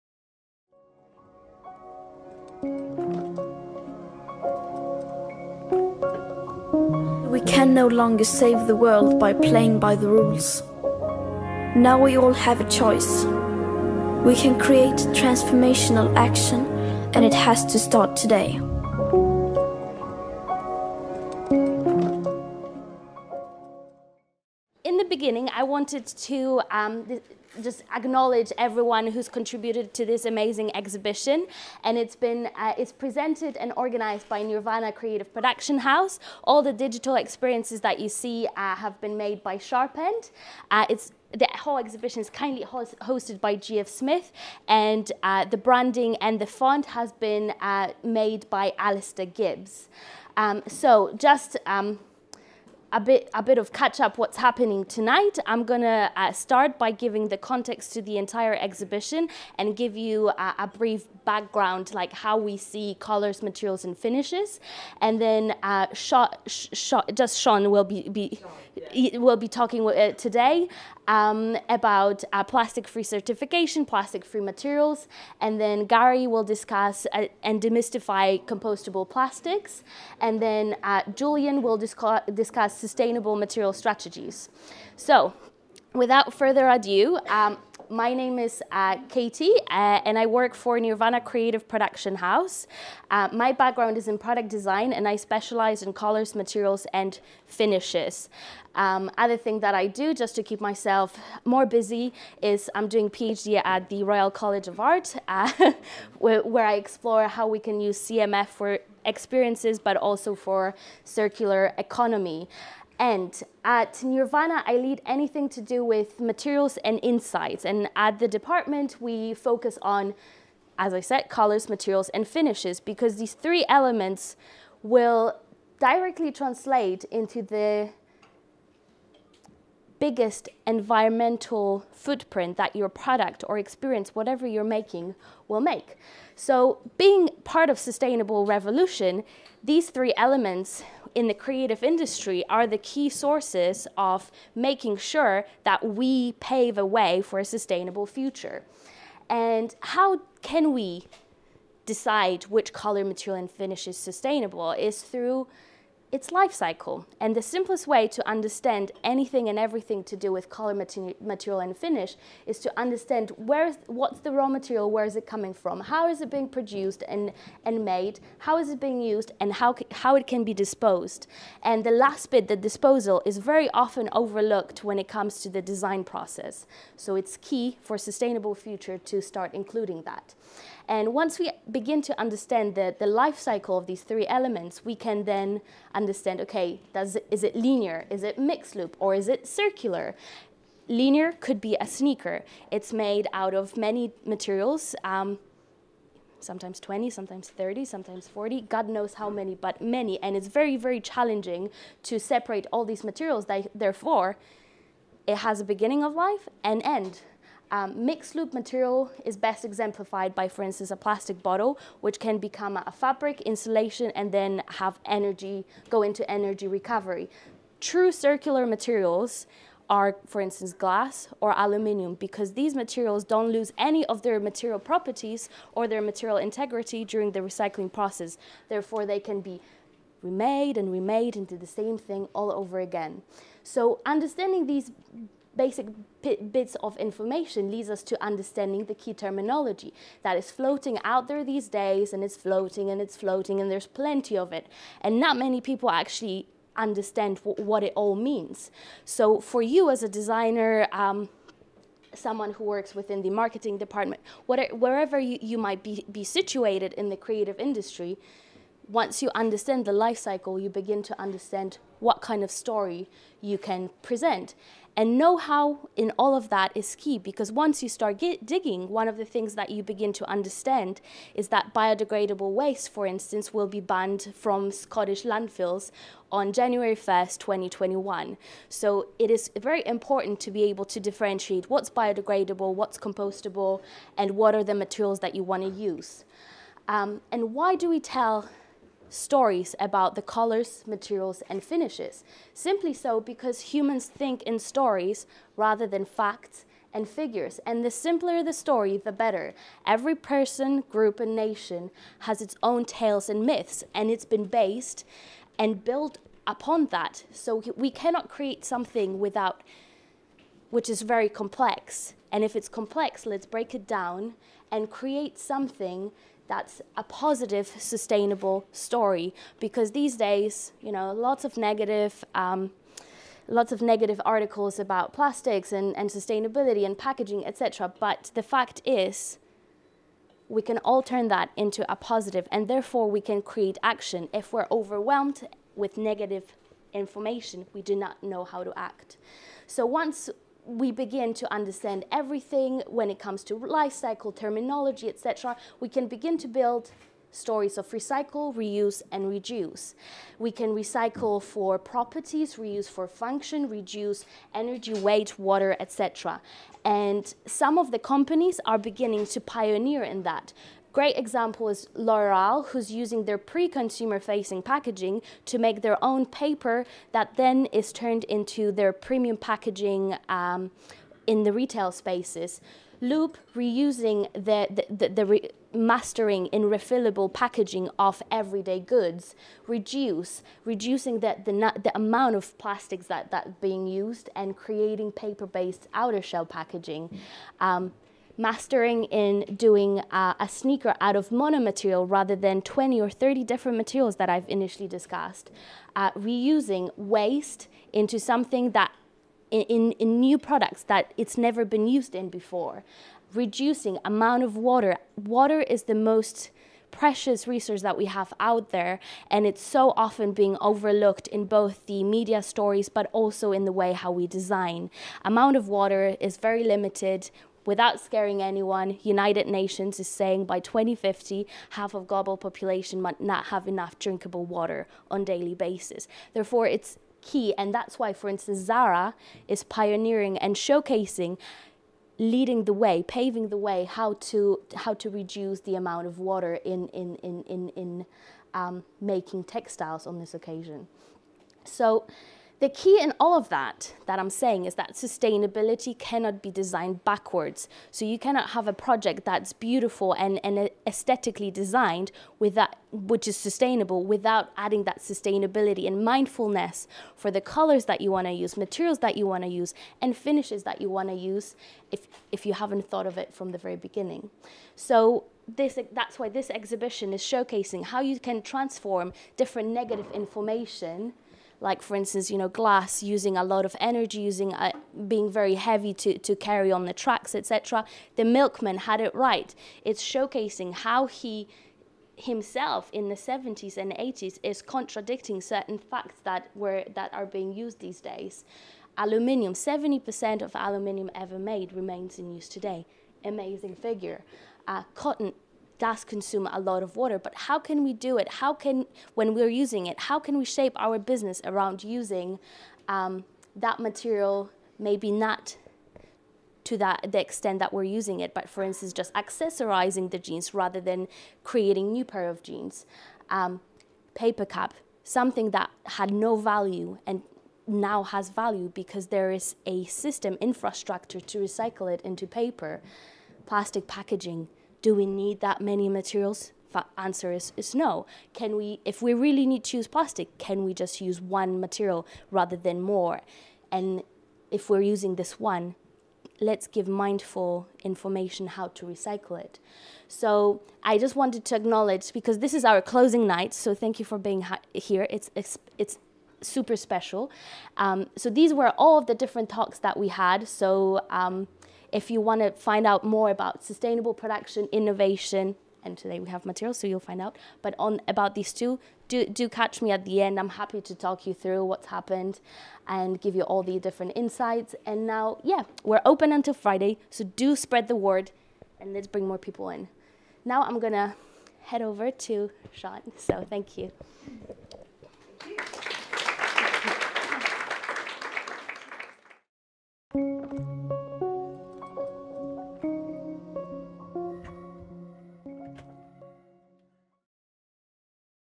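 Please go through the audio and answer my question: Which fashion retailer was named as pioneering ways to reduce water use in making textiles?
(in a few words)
Zara.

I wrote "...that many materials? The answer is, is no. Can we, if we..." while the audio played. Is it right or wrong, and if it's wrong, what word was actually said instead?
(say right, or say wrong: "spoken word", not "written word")
right.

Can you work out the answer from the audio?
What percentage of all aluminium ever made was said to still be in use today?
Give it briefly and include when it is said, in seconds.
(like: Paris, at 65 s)
70%, at 489 s.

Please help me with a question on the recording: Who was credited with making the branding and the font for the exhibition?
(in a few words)
Alistair Gibbs.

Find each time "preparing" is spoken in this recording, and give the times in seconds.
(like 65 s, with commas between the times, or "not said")
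not said.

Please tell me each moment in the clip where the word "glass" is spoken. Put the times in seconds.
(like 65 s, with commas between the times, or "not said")
220 s, 472 s.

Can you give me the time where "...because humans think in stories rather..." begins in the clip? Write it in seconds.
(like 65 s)
293 s.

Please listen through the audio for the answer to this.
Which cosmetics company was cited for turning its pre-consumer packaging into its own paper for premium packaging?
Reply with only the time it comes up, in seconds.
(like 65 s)
361 s.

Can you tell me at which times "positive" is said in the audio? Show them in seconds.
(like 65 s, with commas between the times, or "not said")
317 s, 331 s.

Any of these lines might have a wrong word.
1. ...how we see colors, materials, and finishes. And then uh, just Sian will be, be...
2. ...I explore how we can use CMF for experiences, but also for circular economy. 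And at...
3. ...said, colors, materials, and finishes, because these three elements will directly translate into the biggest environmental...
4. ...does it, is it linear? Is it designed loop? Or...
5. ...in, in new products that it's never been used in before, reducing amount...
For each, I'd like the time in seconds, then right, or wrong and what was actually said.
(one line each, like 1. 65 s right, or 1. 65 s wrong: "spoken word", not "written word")
1. 62 s right
2. 106 s right
3. 120 s right
4. 186 s wrong: "mixed", not "designed"
5. 399 s right.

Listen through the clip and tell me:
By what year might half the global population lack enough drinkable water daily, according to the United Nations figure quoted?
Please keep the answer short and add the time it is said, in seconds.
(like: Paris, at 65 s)
2050, at 420 s.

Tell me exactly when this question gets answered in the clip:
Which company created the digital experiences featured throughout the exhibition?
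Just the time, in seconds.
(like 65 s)
39 s.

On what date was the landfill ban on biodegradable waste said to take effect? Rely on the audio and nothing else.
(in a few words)
January 1st, 2021.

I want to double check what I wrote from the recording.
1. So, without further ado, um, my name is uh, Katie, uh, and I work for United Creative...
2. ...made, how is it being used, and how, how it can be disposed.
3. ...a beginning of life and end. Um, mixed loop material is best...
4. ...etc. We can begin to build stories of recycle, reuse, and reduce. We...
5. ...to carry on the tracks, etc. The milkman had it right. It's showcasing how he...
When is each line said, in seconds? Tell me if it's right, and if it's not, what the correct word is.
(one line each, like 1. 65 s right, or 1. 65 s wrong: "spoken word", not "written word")
1. 84 s wrong: "Nirvana", not "United"
2. 167 s right
3. 205 s right
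4. 345 s right
5. 476 s right.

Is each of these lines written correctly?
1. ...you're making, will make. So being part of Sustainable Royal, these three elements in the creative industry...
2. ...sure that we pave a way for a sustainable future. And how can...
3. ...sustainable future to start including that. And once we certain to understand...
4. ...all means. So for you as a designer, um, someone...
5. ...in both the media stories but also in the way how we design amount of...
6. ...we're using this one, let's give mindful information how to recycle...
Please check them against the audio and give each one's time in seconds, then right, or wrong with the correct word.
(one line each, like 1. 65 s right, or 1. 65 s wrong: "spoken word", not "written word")
1. 134 s wrong: "Revolution", not "Royal"
2. 144 s right
3. 177 s wrong: "begin", not "certain"
4. 247 s right
5. 411 s right
6. 534 s right.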